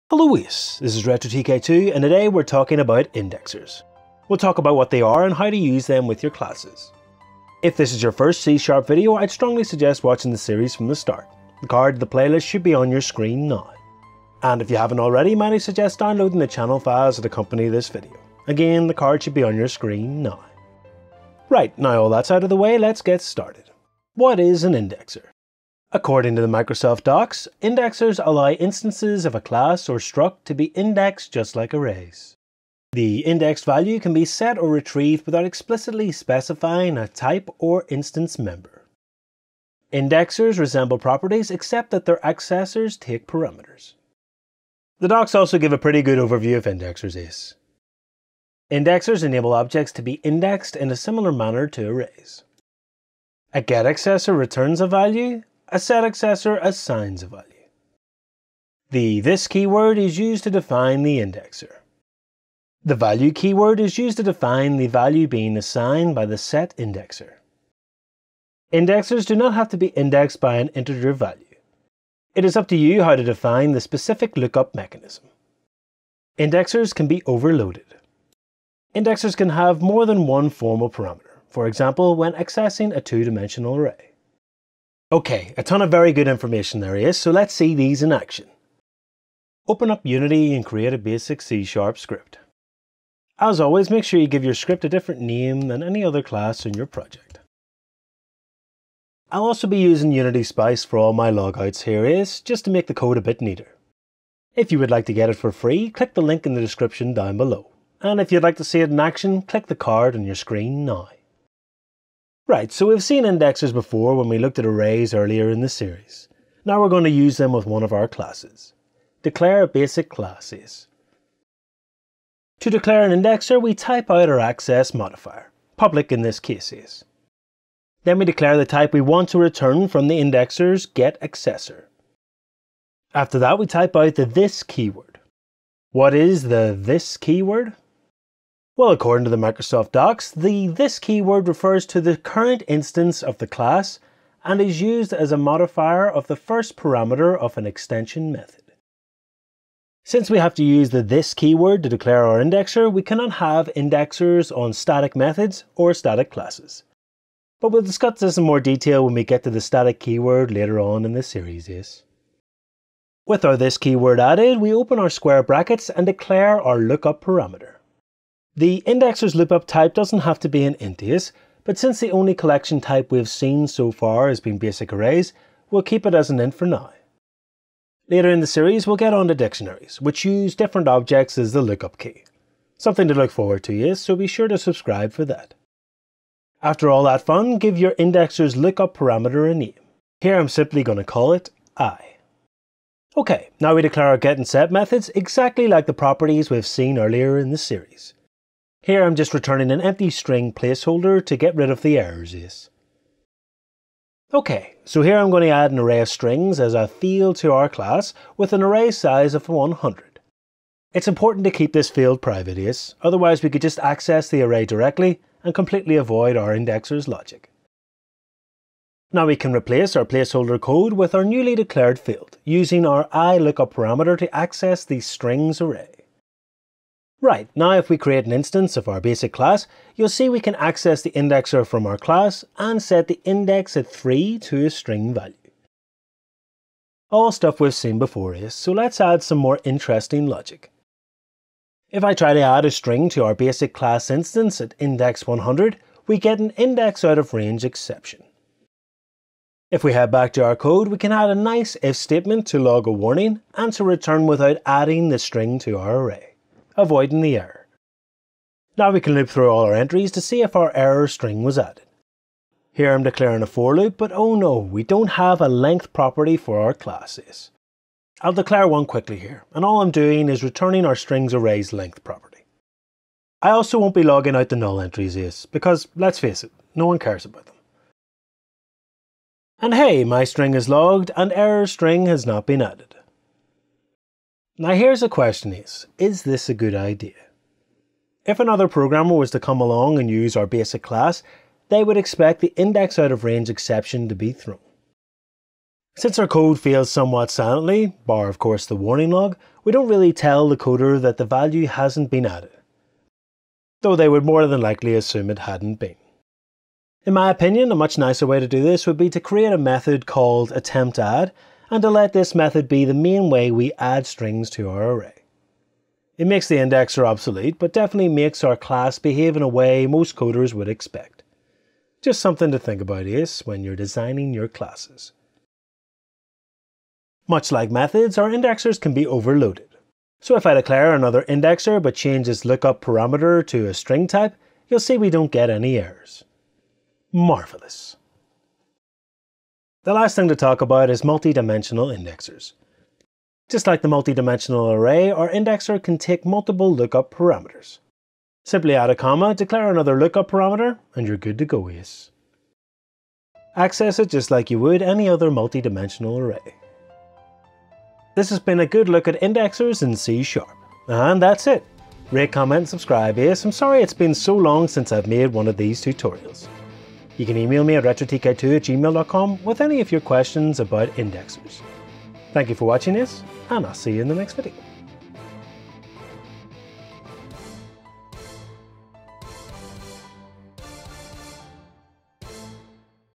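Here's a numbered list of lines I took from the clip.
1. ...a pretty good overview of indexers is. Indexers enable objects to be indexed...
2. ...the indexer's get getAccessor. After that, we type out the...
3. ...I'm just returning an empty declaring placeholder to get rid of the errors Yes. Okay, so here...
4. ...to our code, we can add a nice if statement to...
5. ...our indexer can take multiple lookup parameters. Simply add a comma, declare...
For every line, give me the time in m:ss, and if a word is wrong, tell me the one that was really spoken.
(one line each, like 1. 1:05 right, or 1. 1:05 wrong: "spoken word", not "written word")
1. 0:45 right
2. 2:10 wrong: "accessor", not "getAccessor"
3. 3:19 wrong: "string", not "declaring"
4. 4:10 right
5. 5:45 right.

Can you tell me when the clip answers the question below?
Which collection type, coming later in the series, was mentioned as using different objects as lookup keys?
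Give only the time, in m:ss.
2:59.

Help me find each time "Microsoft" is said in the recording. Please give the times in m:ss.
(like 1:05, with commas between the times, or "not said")
0:26, 2:19.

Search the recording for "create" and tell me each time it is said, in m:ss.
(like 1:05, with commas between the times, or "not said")
1:30, 3:47, 5:09.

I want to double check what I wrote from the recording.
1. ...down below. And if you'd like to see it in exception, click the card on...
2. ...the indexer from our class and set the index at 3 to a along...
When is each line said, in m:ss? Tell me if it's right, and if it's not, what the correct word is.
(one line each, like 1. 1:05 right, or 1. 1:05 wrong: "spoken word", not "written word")
1. 1:47 wrong: "action", not "exception"
2. 3:51 wrong: "string", not "along".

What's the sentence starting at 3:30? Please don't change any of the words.
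It's important to keep this field private Yes.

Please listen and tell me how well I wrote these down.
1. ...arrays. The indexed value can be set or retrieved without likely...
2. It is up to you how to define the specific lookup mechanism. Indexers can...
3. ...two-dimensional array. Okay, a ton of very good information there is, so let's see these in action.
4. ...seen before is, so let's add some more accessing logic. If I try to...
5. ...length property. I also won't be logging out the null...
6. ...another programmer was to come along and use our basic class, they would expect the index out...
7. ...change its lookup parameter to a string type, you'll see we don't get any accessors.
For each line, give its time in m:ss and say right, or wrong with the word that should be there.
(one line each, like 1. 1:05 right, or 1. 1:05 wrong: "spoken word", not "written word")
1. 0:31 wrong: "explicitly", not "likely"
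2. 1:12 right
3. 1:22 right
4. 3:57 wrong: "interesting", not "accessing"
5. 4:31 right
6. 4:48 right
7. 5:31 wrong: "errors", not "accessors".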